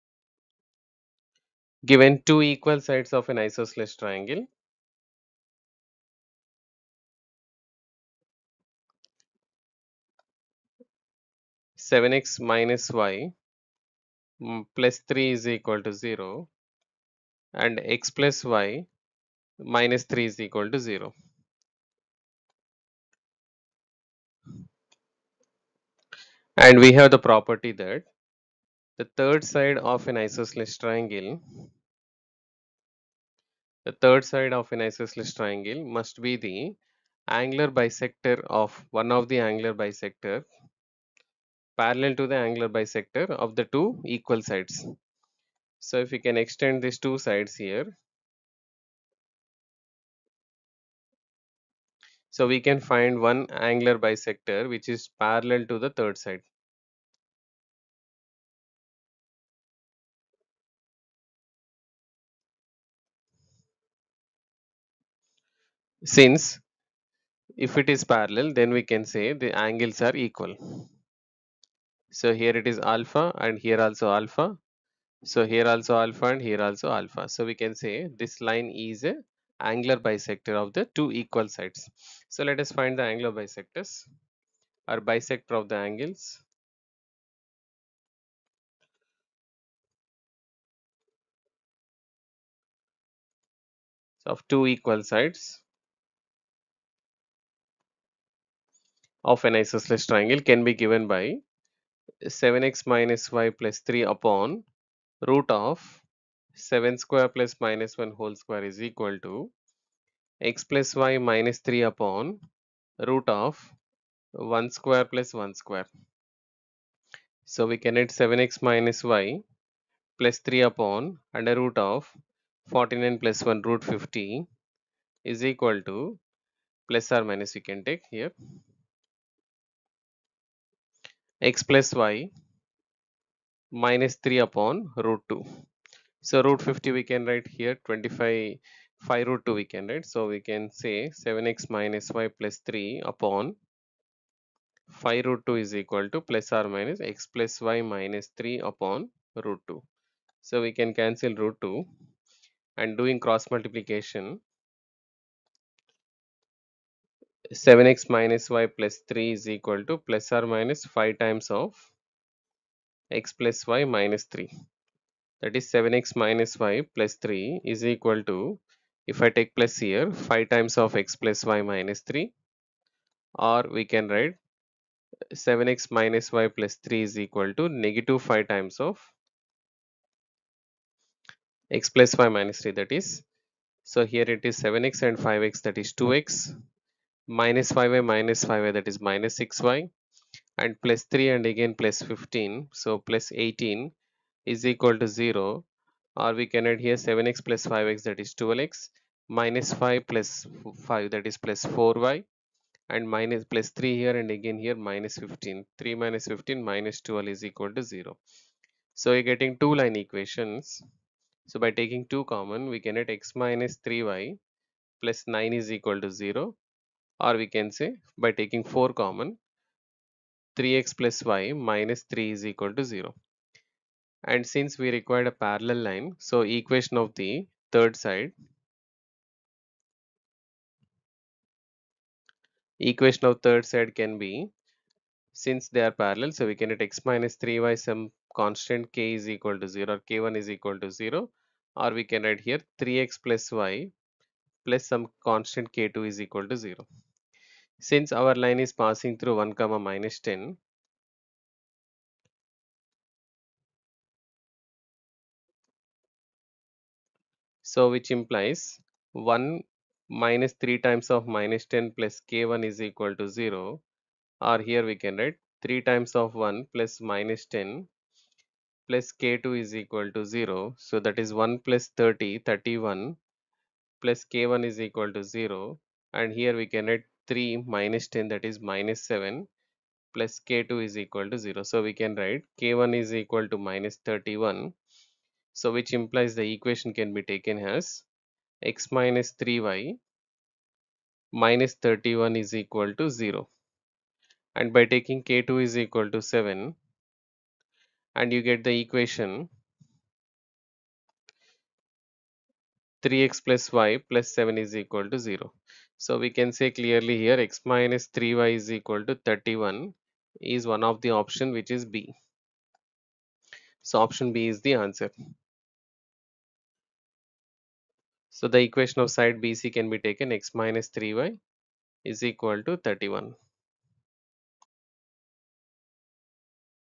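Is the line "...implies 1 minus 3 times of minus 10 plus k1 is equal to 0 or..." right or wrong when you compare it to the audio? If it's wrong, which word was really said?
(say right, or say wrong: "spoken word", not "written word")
right.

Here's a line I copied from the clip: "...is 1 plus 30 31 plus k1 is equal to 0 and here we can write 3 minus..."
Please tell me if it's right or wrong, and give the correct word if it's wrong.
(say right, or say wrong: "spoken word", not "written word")
right.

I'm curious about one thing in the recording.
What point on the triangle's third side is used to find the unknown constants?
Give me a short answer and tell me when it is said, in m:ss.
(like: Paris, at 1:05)
(1, -10), at 4:09.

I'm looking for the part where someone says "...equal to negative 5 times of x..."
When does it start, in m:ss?
2:57.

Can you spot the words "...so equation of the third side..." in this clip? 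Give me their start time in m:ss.
3:46.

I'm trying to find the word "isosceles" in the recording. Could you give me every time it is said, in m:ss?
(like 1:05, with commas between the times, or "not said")
0:03, 0:30, 0:34, 1:39.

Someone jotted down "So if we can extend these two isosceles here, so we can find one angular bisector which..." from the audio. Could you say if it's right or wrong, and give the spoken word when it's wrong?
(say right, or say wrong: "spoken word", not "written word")
wrong: "sides", not "isosceles".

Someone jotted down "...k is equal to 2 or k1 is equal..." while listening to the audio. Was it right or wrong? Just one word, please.
wrong.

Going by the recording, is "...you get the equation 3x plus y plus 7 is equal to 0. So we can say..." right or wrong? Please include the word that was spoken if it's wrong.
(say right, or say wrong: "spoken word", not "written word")
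right.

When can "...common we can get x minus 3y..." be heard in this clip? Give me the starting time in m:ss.
3:32.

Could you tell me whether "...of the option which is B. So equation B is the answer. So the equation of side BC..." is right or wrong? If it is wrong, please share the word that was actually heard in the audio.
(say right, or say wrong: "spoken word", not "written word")
wrong: "option", not "equation".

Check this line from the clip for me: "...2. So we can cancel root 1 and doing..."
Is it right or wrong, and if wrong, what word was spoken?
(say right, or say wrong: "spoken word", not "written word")
wrong: "2", not "1".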